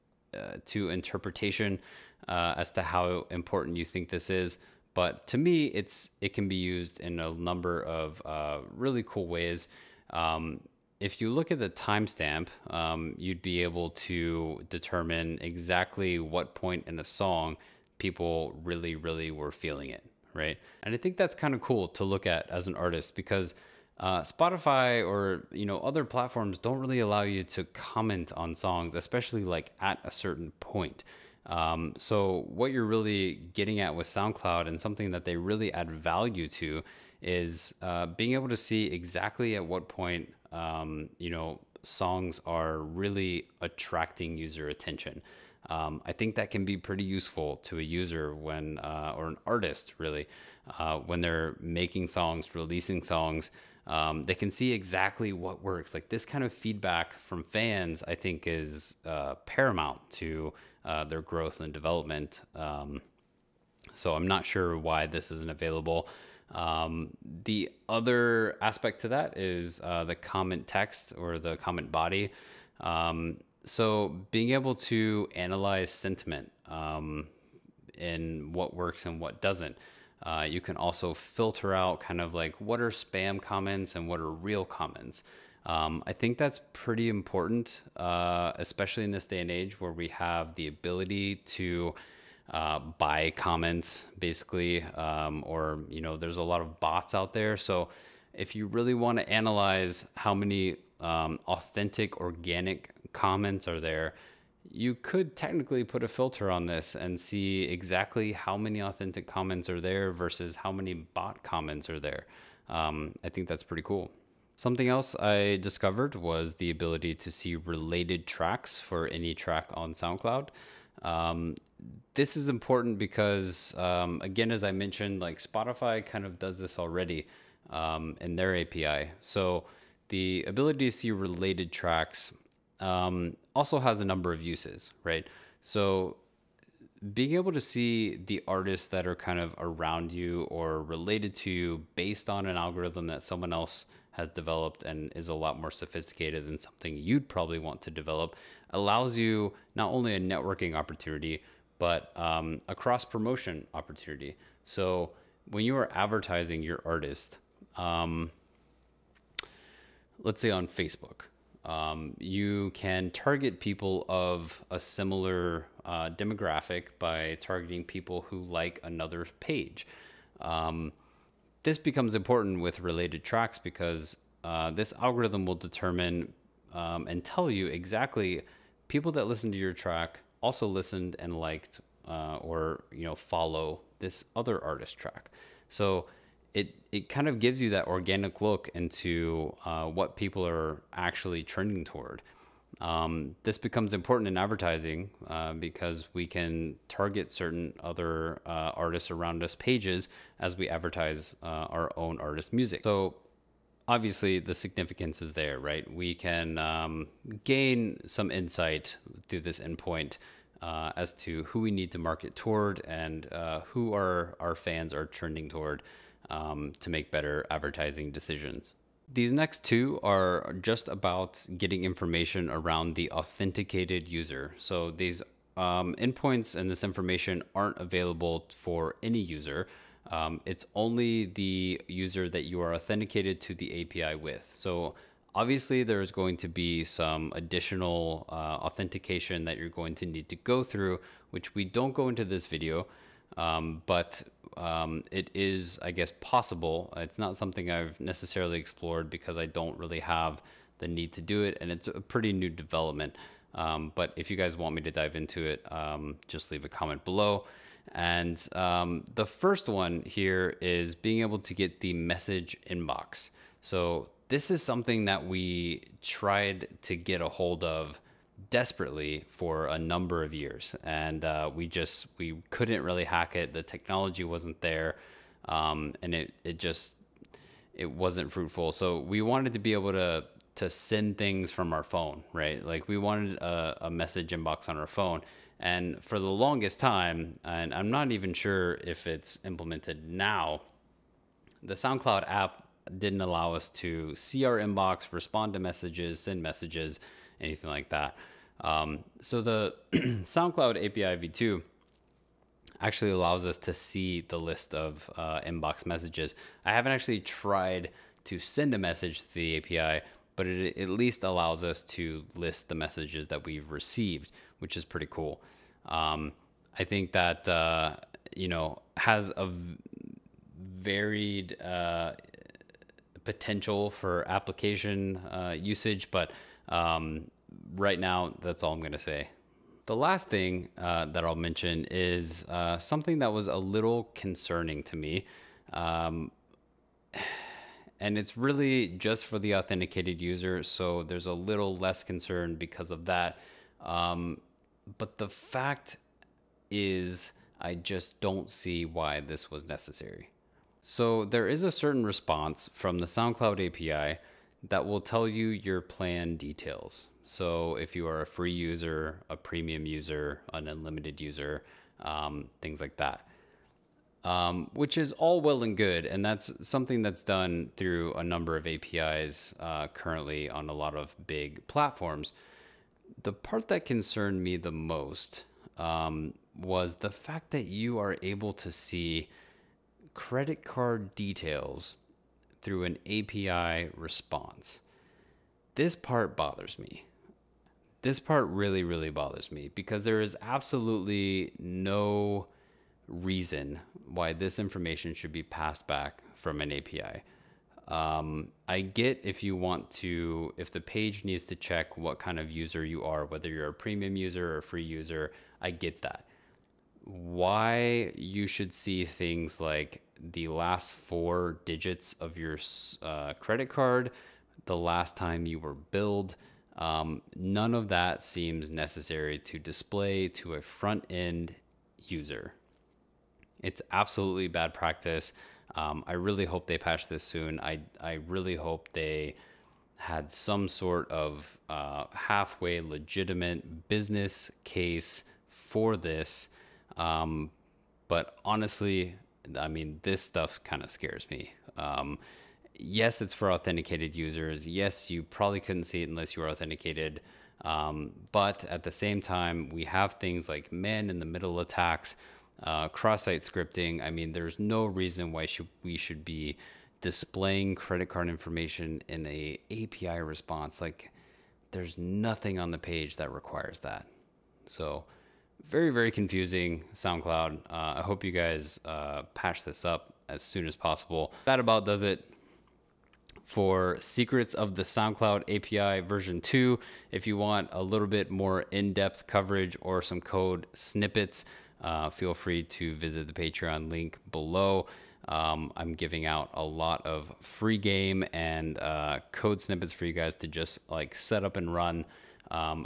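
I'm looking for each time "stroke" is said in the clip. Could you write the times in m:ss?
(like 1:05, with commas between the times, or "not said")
not said.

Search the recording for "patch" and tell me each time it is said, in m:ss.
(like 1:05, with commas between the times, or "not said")
7:06, 7:49.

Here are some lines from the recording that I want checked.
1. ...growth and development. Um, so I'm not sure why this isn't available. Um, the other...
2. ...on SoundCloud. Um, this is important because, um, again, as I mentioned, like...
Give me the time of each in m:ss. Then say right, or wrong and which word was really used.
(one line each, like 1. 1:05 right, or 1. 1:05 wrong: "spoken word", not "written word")
1. 1:01 right
2. 1:59 right.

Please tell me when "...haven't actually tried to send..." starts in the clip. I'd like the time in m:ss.
5:06.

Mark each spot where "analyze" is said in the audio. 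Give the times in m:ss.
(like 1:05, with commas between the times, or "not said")
1:15, 1:39.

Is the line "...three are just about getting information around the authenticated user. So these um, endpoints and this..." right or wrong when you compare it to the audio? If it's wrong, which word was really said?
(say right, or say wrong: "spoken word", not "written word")
wrong: "two", not "three".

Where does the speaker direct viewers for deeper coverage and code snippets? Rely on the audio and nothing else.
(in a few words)
Patreon.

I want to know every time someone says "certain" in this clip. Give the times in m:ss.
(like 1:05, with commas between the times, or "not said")
0:30, 3:17, 5:51.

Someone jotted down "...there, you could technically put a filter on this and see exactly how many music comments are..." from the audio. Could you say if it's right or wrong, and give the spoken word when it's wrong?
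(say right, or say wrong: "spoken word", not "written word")
wrong: "authentic", not "music".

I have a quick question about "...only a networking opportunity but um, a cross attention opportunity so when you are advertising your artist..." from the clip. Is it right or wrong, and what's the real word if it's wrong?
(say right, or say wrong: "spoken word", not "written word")
wrong: "promotion", not "attention".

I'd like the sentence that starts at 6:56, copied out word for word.
Um, none of that seems necessary to display to a front end user.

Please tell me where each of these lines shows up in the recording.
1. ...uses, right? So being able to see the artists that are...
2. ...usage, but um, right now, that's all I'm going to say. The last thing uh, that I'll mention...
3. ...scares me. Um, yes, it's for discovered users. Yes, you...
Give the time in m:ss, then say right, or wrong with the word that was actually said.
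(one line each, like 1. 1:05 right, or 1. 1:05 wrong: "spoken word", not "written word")
1. 2:14 right
2. 5:25 right
3. 7:20 wrong: "authenticated", not "discovered".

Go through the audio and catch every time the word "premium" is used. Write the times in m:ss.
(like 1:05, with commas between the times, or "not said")
5:59, 6:43.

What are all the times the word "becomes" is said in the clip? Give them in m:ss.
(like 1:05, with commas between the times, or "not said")
2:51, 3:13.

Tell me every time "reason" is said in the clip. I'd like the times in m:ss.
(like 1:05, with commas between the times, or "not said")
6:33, 7:34.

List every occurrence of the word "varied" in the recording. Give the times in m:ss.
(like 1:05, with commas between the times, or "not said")
5:20.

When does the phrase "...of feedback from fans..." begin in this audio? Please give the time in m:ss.
0:56.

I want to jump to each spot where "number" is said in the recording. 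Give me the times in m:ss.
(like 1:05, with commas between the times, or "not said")
0:07, 2:14, 4:29, 6:08.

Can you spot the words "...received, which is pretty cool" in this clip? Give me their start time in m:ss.
5:13.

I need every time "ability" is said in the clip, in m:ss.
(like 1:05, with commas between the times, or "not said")
1:30, 1:56, 2:10.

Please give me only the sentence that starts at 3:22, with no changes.
So obviously the significance is there, right?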